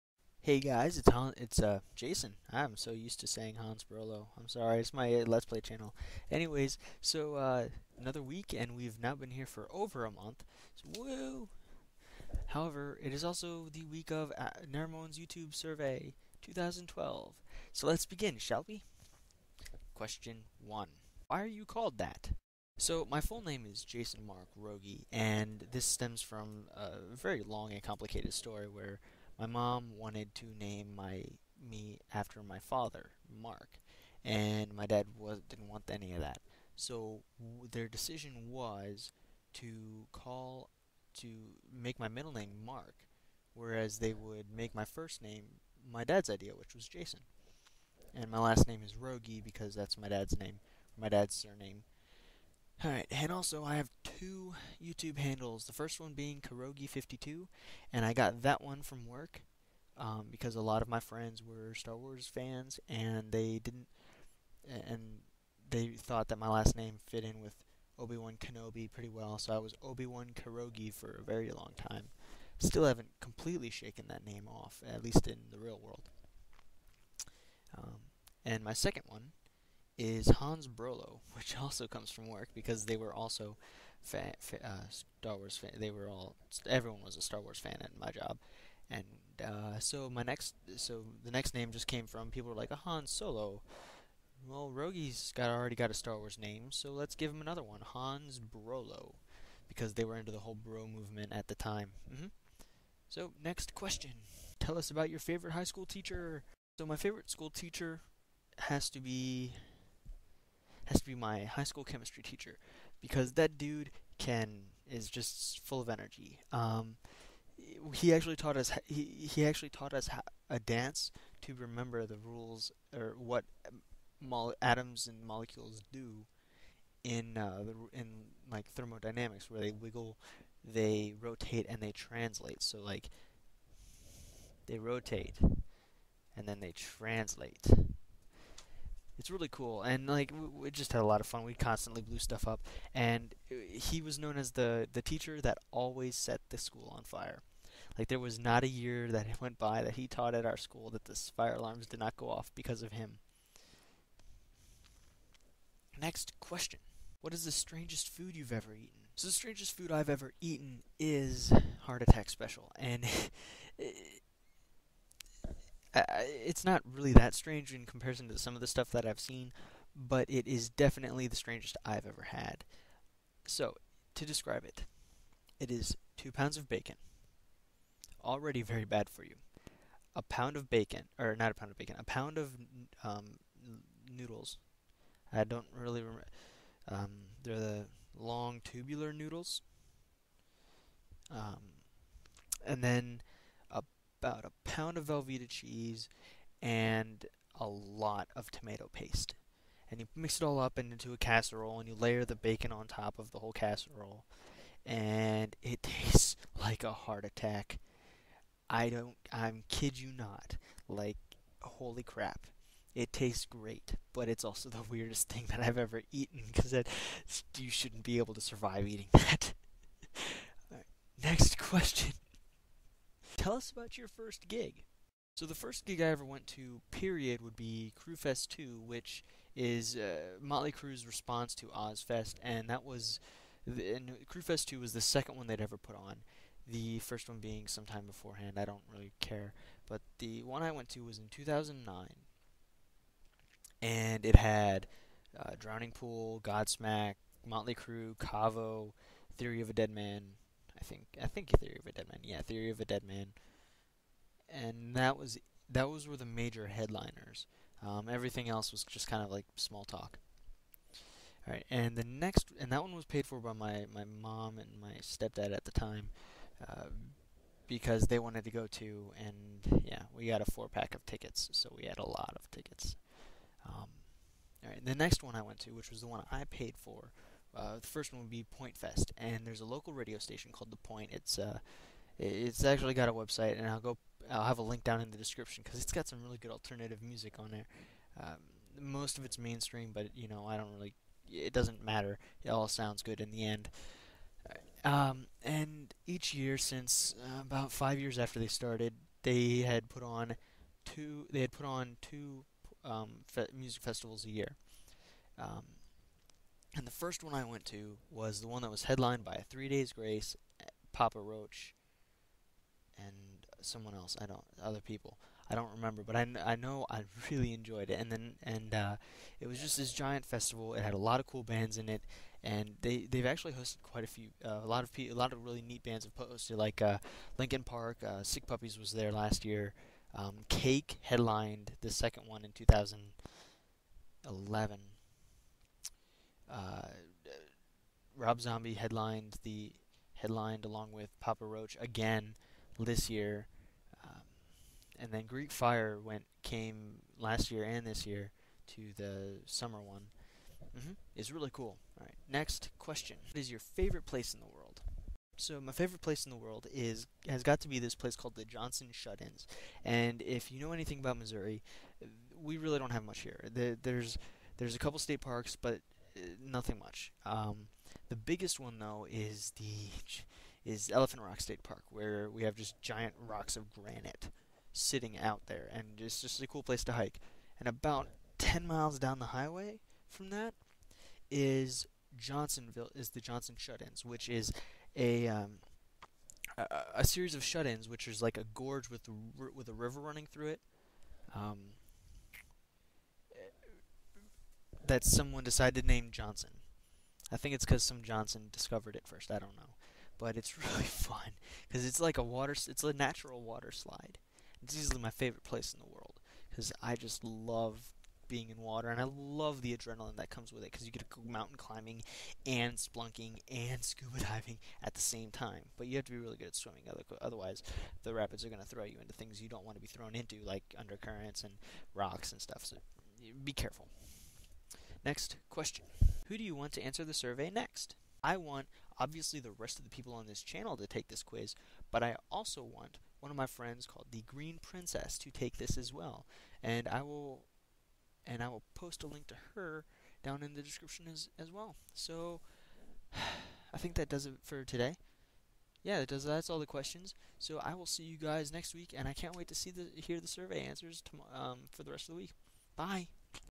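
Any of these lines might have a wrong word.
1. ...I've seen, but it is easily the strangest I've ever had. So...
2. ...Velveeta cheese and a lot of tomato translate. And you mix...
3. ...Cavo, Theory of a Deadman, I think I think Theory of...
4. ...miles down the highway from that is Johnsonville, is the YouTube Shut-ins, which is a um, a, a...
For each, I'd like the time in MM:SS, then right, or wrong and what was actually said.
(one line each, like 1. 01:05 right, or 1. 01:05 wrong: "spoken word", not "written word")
1. 02:49 wrong: "definitely", not "easily"
2. 03:15 wrong: "paste", not "translate"
3. 04:08 right
4. 06:18 wrong: "Johnson", not "YouTube".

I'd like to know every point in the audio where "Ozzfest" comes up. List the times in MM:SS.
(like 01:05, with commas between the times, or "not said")
03:51.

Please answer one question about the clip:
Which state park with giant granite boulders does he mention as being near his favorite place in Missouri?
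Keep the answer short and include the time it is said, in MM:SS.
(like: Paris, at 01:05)
Elephant Rock State Park, at 06:10.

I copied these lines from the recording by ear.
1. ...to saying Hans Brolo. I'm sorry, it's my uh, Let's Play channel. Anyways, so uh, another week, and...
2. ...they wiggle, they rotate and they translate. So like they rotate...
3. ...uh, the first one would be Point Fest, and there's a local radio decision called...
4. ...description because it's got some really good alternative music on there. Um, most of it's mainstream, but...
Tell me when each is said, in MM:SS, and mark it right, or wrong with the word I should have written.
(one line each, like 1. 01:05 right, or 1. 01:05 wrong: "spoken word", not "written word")
1. 00:03 right
2. 02:09 right
3. 04:37 wrong: "station", not "decision"
4. 04:45 right.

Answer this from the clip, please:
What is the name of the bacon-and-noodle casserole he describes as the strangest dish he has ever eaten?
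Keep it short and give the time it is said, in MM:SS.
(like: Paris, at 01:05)
Heart attack special, at 02:41.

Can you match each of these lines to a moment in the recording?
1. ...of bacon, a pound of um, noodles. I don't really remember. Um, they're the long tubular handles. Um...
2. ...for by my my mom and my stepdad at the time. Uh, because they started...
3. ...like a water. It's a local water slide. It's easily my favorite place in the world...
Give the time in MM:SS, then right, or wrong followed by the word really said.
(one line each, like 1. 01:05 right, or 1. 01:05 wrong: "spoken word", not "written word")
1. 03:01 wrong: "noodles", not "handles"
2. 04:23 wrong: "wanted", not "started"
3. 06:42 wrong: "natural", not "local".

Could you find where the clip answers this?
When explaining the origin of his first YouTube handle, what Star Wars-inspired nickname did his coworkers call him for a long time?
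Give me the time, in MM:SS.
01:09.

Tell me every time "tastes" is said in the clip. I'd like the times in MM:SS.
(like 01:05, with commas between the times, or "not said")
03:25, 03:33.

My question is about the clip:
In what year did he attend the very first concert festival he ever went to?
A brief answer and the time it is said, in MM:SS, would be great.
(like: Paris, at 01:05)
2009, at 04:01.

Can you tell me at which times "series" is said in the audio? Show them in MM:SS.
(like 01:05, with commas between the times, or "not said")
06:27.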